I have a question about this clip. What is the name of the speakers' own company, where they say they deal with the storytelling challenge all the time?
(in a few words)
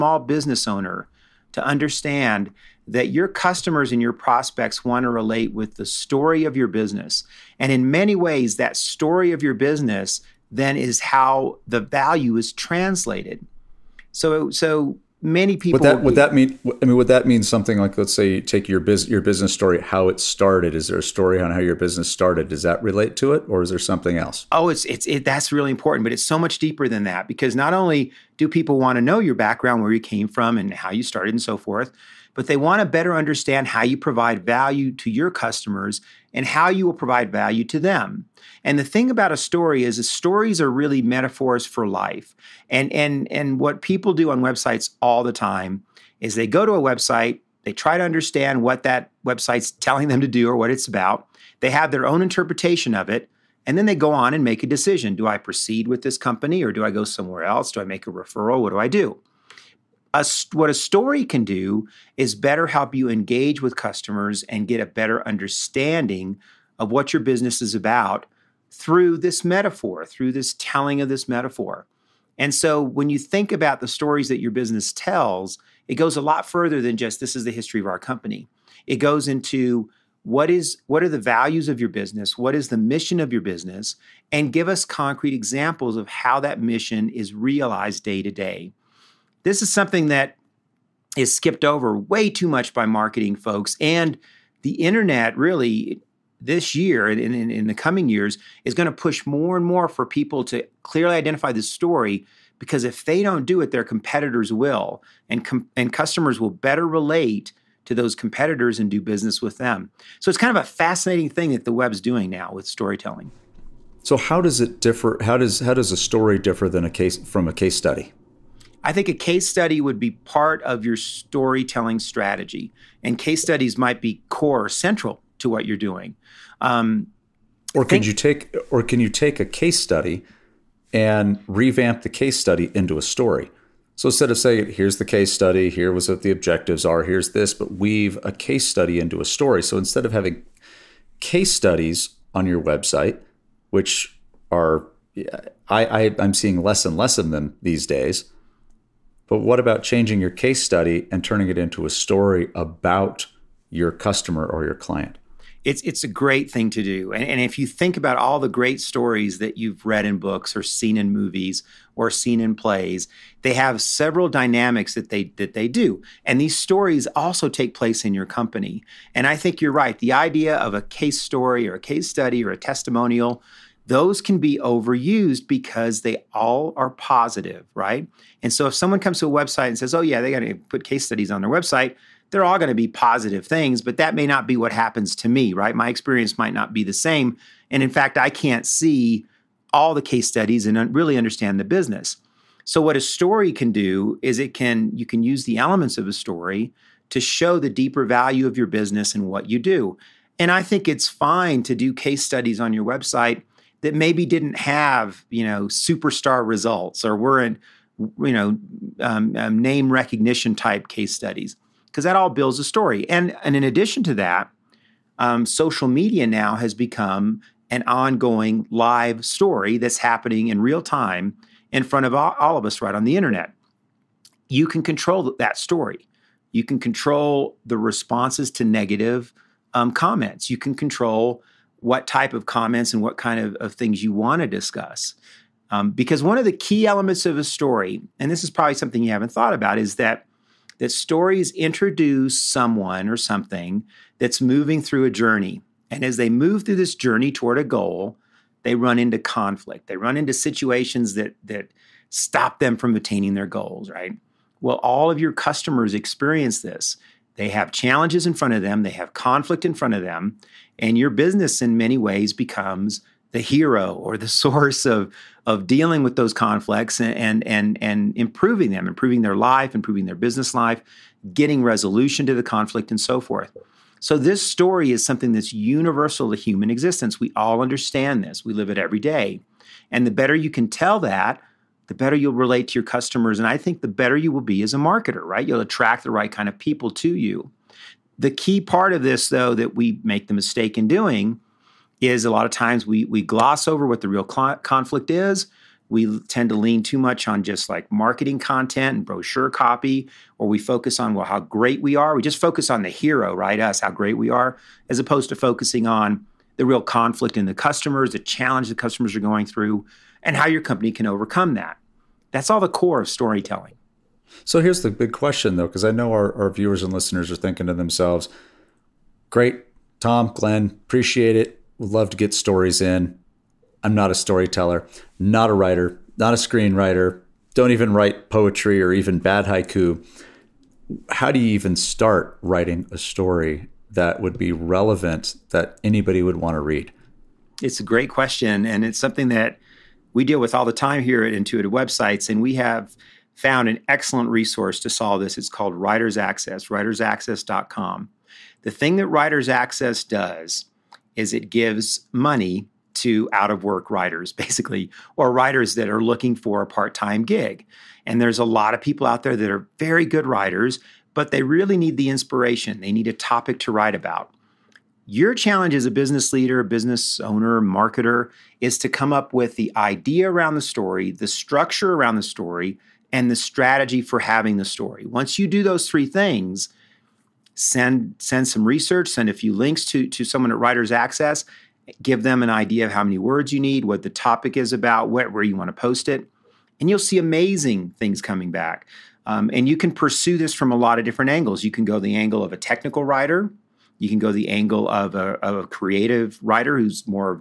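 Intuitive Websites.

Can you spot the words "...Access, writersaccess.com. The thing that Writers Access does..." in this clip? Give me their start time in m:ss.
5:46.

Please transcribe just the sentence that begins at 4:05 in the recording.
And as they move through this journey toward a goal, they run into conflict.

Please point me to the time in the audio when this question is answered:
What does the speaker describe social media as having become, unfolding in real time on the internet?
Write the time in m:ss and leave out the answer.
3:37.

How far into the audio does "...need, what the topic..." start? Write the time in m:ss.
6:23.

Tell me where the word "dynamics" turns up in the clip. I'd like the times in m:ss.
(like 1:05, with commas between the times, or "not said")
2:44.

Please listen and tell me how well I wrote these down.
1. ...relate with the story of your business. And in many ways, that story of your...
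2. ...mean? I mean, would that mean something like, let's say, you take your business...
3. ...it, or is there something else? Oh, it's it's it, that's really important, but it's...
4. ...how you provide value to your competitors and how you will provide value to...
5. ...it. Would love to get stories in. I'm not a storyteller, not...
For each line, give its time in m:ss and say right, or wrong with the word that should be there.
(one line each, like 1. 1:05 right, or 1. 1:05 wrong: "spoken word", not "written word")
1. 0:05 right
2. 0:16 right
3. 0:23 right
4. 0:33 wrong: "customers", not "competitors"
5. 5:21 right.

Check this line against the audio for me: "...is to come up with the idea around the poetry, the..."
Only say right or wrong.
wrong.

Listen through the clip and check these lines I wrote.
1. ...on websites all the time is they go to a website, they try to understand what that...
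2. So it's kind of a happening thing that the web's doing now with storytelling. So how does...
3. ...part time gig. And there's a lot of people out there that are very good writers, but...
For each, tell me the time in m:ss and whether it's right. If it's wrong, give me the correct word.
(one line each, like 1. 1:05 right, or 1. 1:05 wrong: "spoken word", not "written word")
1. 0:44 right
2. 1:50 wrong: "fascinating", not "happening"
3. 5:56 right.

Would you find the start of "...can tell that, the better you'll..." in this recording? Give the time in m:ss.
4:40.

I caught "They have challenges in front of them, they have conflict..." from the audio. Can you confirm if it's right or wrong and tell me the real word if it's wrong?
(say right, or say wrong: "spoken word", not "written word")
right.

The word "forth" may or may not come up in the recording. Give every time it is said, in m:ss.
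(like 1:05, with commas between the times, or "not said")
0:31, 4:33.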